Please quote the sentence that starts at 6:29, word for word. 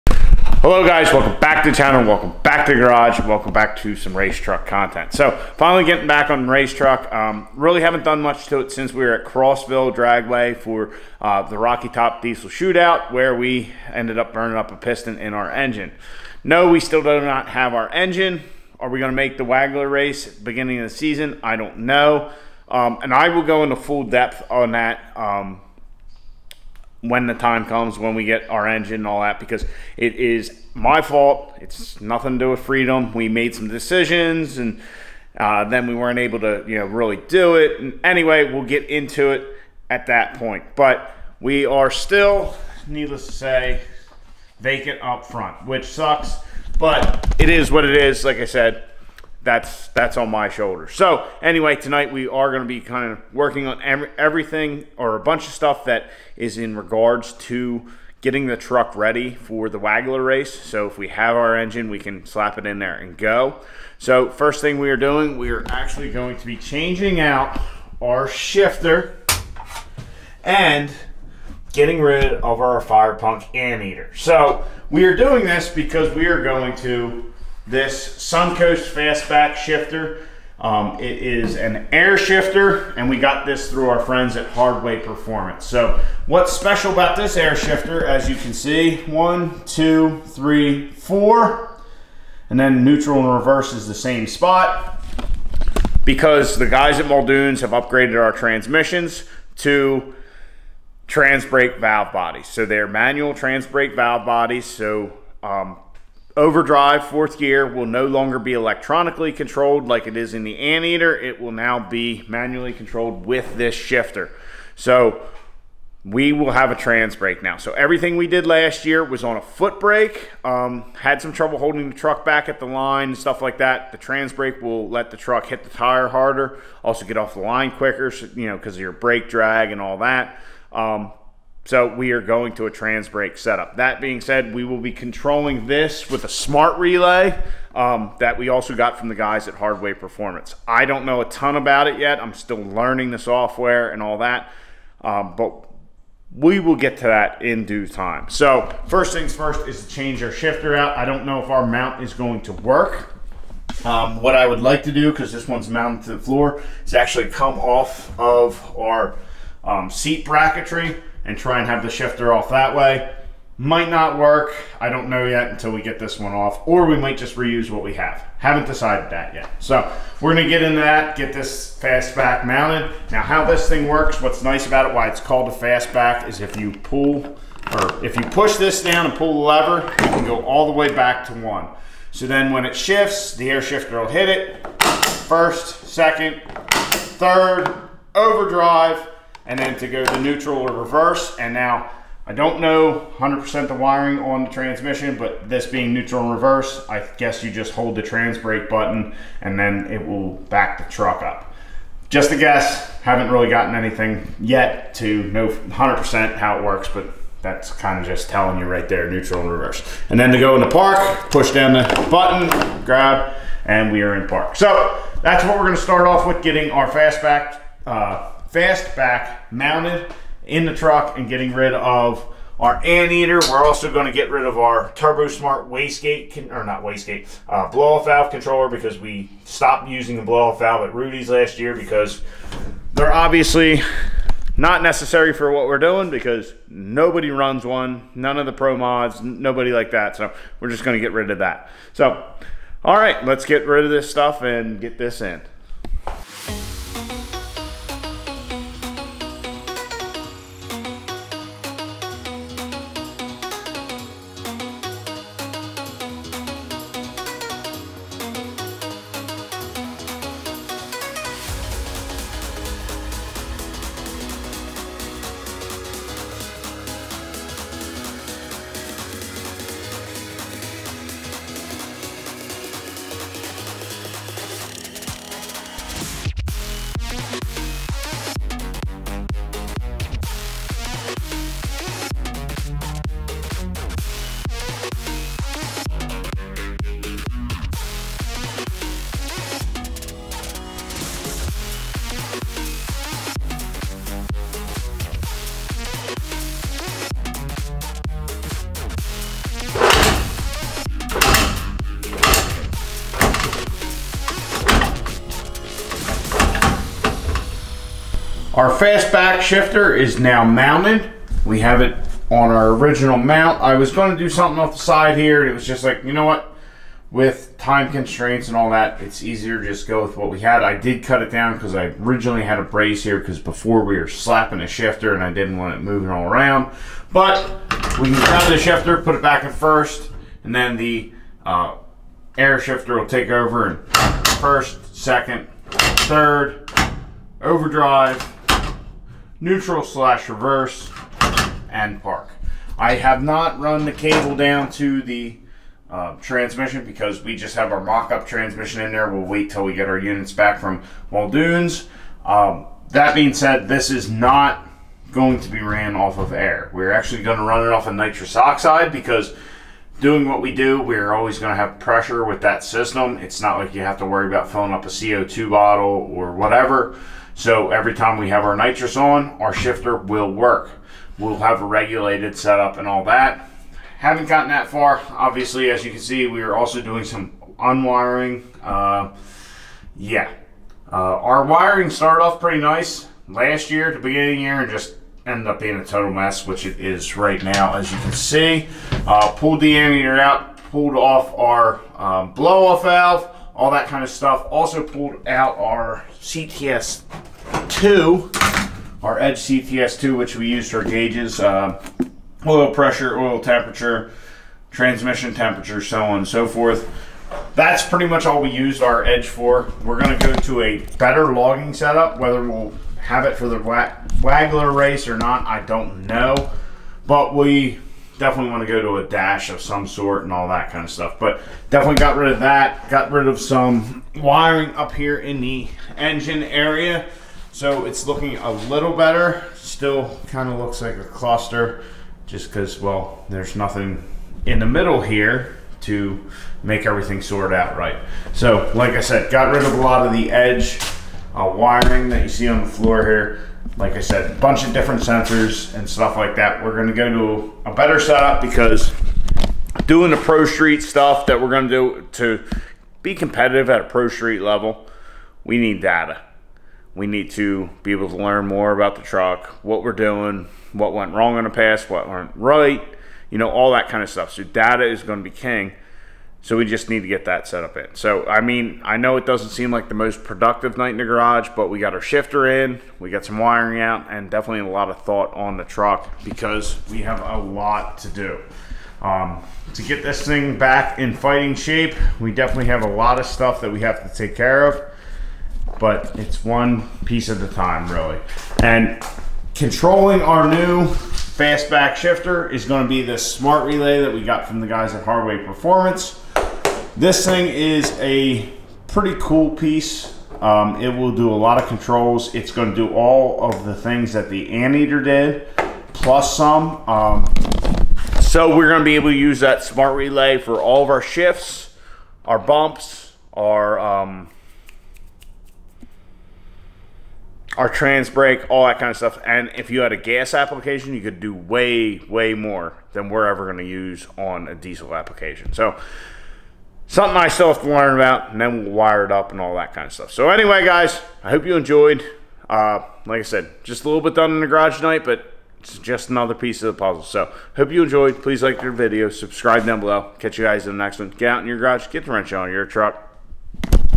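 Uh, pulled the ammeter out, pulled off our um, blow-off valve, all that kind of stuff.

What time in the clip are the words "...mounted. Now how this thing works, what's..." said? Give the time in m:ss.
2:52.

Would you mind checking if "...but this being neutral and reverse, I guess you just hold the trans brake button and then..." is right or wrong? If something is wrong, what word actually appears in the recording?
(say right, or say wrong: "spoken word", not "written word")
right.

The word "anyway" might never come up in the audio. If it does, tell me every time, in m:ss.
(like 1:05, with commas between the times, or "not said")
0:38, 0:51, 8:50.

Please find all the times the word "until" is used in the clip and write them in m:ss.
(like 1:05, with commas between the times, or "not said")
2:45.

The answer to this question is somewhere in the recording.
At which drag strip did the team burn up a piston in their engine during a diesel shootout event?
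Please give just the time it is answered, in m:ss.
0:09.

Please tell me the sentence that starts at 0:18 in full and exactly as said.
Are we going to make the Wagler race beginning of the season?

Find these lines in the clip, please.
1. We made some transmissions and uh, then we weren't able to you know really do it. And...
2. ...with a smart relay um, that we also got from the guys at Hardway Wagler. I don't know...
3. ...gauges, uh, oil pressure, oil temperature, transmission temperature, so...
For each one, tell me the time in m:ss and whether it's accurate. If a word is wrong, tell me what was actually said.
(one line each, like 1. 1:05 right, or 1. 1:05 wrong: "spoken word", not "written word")
1. 0:33 wrong: "decisions", not "transmissions"
2. 2:16 wrong: "Performance", not "Wagler"
3. 6:40 right.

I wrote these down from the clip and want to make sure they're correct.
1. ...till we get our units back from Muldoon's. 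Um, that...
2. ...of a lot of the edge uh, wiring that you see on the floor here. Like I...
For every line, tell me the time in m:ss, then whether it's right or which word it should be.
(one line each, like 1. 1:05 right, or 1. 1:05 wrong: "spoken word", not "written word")
1. 5:49 right
2. 7:19 right.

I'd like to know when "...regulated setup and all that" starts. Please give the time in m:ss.
6:11.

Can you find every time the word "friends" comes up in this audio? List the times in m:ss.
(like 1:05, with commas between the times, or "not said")
1:23.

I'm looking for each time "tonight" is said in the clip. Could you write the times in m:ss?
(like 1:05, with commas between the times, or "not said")
0:51, 8:54.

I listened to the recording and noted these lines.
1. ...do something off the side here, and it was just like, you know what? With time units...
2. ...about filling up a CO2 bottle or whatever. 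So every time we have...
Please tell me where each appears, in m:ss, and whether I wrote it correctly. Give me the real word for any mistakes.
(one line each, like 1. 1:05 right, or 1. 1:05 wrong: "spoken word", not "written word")
1. 5:14 wrong: "constraints", not "units"
2. 6:04 right.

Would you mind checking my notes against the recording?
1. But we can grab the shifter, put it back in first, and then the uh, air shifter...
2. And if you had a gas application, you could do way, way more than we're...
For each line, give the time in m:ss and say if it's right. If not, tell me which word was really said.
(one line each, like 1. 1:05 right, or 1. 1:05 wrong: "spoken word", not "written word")
1. 5:27 right
2. 8:39 right.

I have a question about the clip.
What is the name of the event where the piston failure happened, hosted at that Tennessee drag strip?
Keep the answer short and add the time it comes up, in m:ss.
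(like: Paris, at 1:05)
Rocky Top Diesel Shootout, at 0:11.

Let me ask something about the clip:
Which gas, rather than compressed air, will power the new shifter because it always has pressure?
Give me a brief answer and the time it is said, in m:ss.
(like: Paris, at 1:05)
Nitrous oxide, at 5:57.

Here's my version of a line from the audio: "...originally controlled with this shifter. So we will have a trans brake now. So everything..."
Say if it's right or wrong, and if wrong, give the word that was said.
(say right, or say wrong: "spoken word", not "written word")
wrong: "manually", not "originally".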